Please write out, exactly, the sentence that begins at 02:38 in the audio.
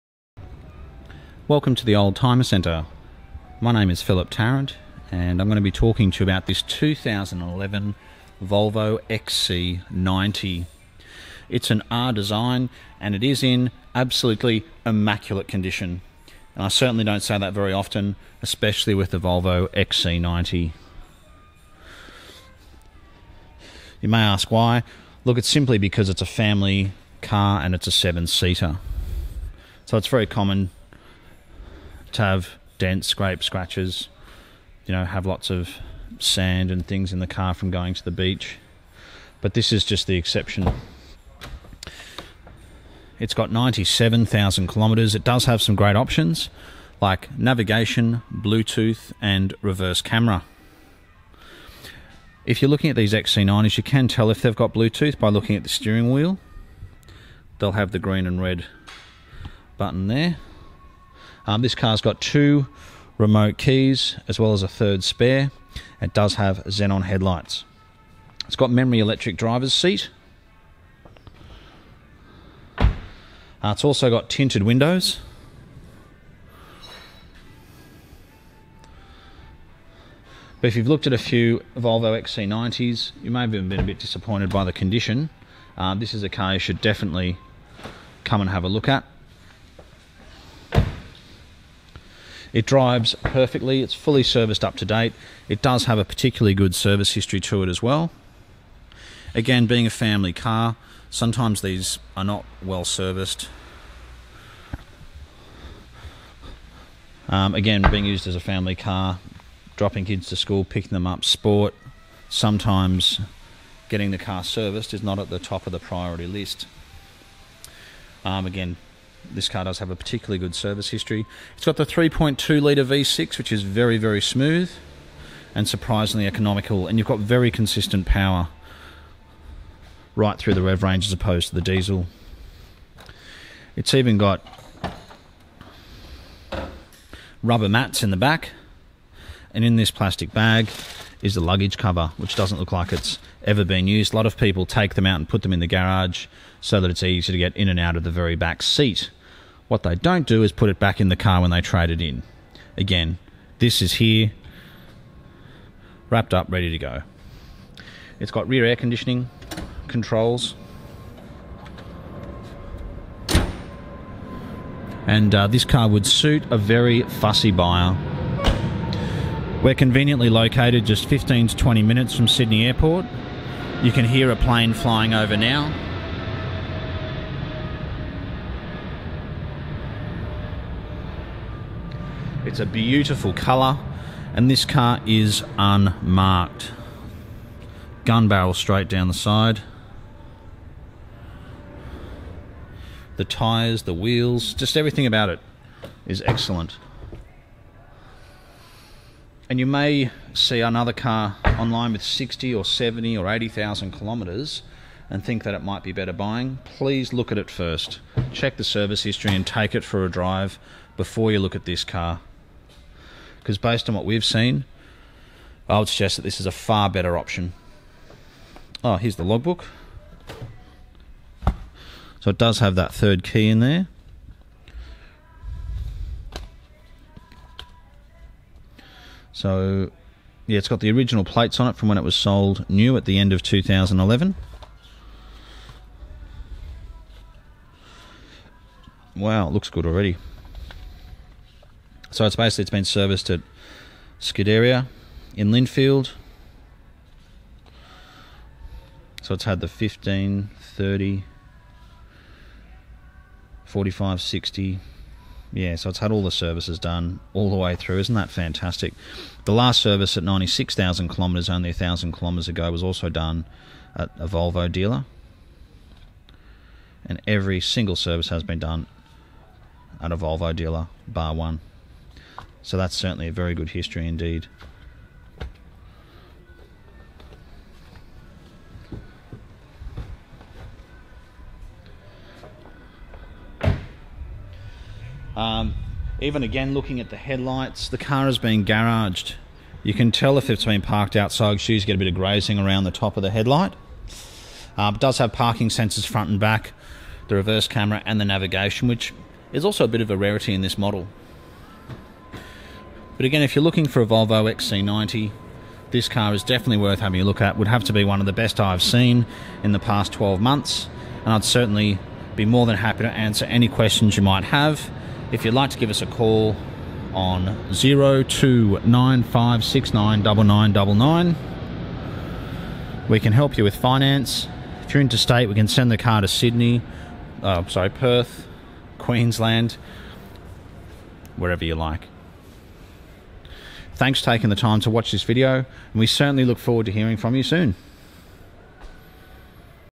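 It's got rear air conditioning controls.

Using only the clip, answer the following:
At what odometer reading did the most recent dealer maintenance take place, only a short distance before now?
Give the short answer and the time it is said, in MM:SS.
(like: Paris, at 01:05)
96,000 kilometres, at 04:20.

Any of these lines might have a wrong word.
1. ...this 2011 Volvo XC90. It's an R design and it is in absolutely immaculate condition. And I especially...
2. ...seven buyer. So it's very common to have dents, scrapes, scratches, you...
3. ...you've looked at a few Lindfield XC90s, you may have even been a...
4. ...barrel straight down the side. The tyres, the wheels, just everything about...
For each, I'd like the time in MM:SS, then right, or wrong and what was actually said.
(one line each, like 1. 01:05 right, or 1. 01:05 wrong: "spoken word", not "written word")
1. 00:06 wrong: "certainly", not "especially"
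2. 00:27 wrong: "seater", not "buyer"
3. 01:20 wrong: "Volvo", not "Lindfield"
4. 03:08 right.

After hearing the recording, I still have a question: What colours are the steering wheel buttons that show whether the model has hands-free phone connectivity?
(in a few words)
green and red.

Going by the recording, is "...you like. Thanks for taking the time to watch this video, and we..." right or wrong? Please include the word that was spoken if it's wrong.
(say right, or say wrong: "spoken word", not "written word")
right.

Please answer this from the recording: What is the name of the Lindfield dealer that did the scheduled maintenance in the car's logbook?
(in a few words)
Scuderia.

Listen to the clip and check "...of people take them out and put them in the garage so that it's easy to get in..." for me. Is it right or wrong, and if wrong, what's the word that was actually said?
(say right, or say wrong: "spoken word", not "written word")
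right.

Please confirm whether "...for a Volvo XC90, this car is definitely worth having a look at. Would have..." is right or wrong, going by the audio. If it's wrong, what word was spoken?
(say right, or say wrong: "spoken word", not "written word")
right.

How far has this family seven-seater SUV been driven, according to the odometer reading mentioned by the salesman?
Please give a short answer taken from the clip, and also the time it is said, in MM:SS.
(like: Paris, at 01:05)
97,000 kilometres, at 00:43.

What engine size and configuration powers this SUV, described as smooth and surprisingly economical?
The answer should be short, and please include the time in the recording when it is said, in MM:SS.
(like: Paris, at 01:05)
3.2 litre V6, at 02:01.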